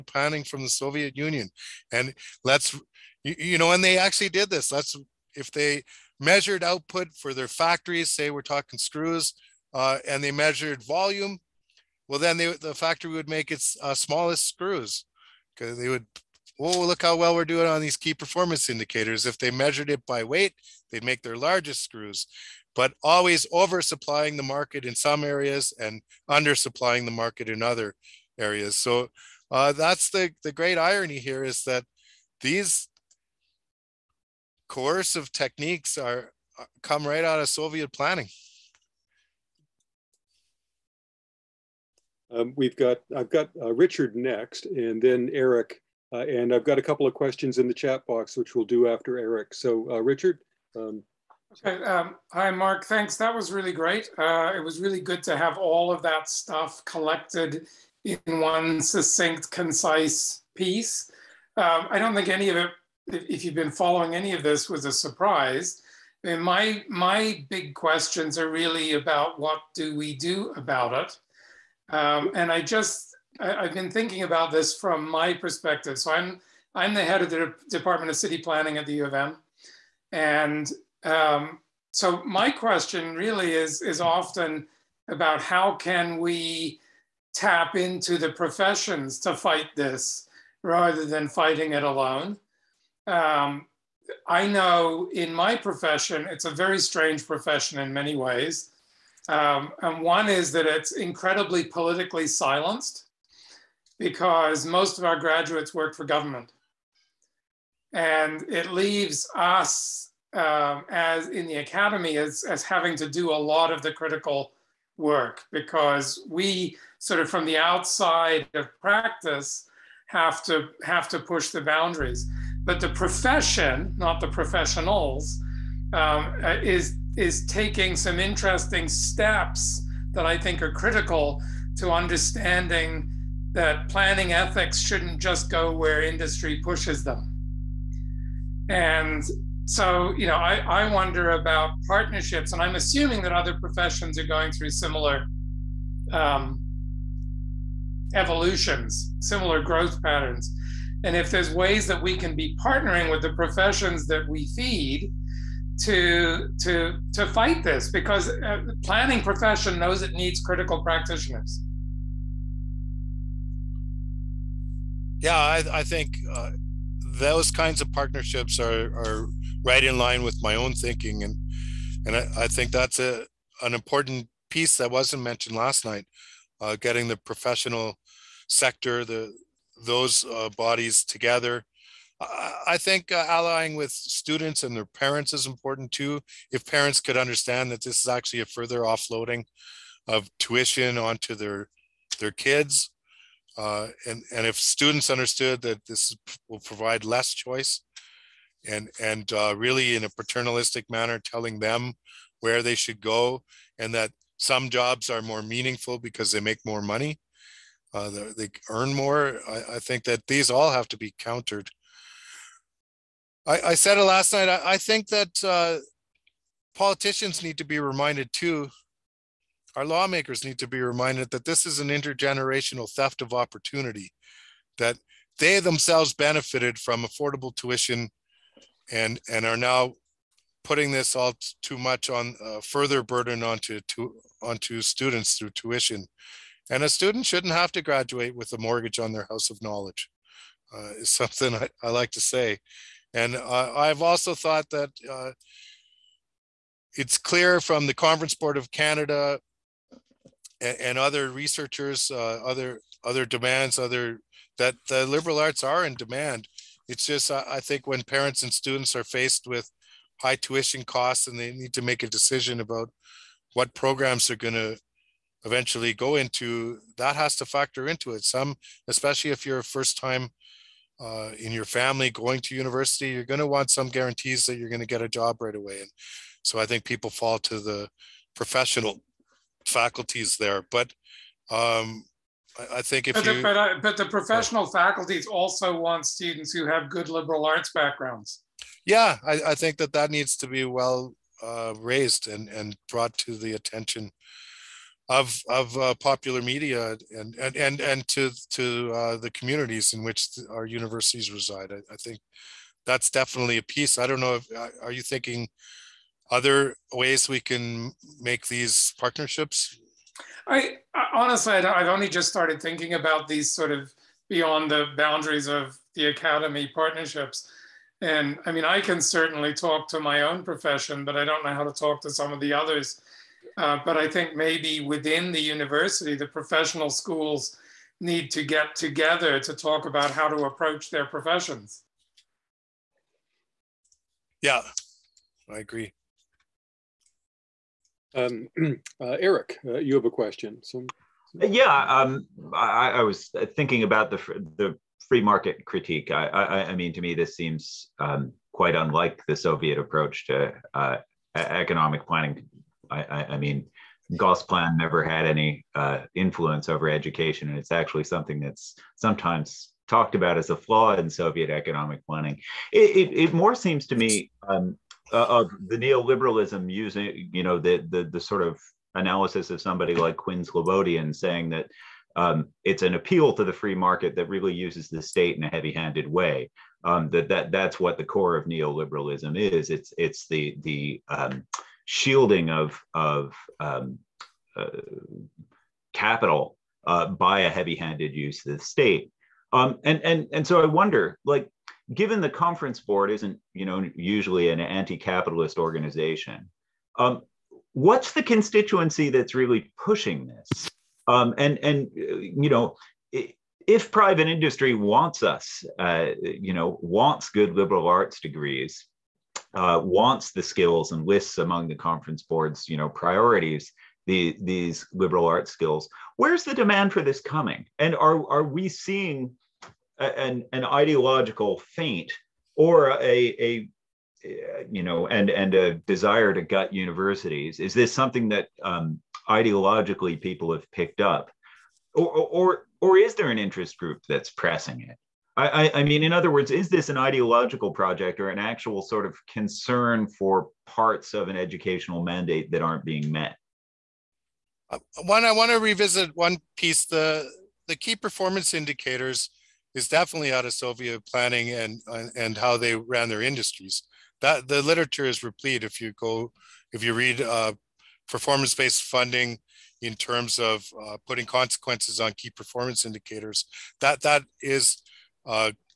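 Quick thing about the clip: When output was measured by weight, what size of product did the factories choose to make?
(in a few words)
Largest.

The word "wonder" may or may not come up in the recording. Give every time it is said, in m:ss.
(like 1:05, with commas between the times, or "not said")
2:20, 6:30.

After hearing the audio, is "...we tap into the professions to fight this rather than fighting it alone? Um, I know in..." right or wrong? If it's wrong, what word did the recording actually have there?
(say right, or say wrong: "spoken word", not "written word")
right.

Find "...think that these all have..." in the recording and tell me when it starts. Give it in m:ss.
3:29.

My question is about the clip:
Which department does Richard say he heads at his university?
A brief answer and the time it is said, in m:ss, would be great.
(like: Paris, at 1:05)
Department of City Planning, at 1:17.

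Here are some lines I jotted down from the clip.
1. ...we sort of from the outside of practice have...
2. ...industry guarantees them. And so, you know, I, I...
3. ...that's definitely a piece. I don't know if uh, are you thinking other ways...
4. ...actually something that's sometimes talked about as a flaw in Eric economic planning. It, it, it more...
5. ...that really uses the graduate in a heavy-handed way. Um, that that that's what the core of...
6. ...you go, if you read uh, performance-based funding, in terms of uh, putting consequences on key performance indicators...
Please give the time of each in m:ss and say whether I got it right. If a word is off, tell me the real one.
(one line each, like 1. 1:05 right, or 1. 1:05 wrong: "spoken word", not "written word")
1. 1:56 right
2. 2:16 wrong: "pushes", not "guarantees"
3. 5:02 right
4. 5:57 wrong: "Soviet", not "Eric"
5. 6:14 wrong: "state", not "graduate"
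6. 7:35 right.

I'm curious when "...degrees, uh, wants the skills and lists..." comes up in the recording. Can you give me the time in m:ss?
6:48.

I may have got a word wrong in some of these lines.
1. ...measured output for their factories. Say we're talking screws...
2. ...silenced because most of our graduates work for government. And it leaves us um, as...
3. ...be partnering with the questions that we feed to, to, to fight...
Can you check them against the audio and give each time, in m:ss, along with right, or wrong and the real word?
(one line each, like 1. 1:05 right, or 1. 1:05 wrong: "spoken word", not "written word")
1. 0:06 right
2. 1:42 right
3. 2:32 wrong: "professions", not "questions".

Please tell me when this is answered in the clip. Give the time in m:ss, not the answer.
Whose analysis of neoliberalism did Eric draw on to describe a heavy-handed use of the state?
6:10.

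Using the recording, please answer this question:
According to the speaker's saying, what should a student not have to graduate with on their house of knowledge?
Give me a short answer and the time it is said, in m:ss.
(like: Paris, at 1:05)
A mortgage, at 3:58.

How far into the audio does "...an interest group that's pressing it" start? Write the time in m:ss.
7:13.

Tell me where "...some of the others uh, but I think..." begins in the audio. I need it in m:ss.
5:22.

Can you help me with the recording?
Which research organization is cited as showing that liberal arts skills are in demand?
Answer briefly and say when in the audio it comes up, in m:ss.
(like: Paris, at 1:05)
Conference Board of Canada, at 4:07.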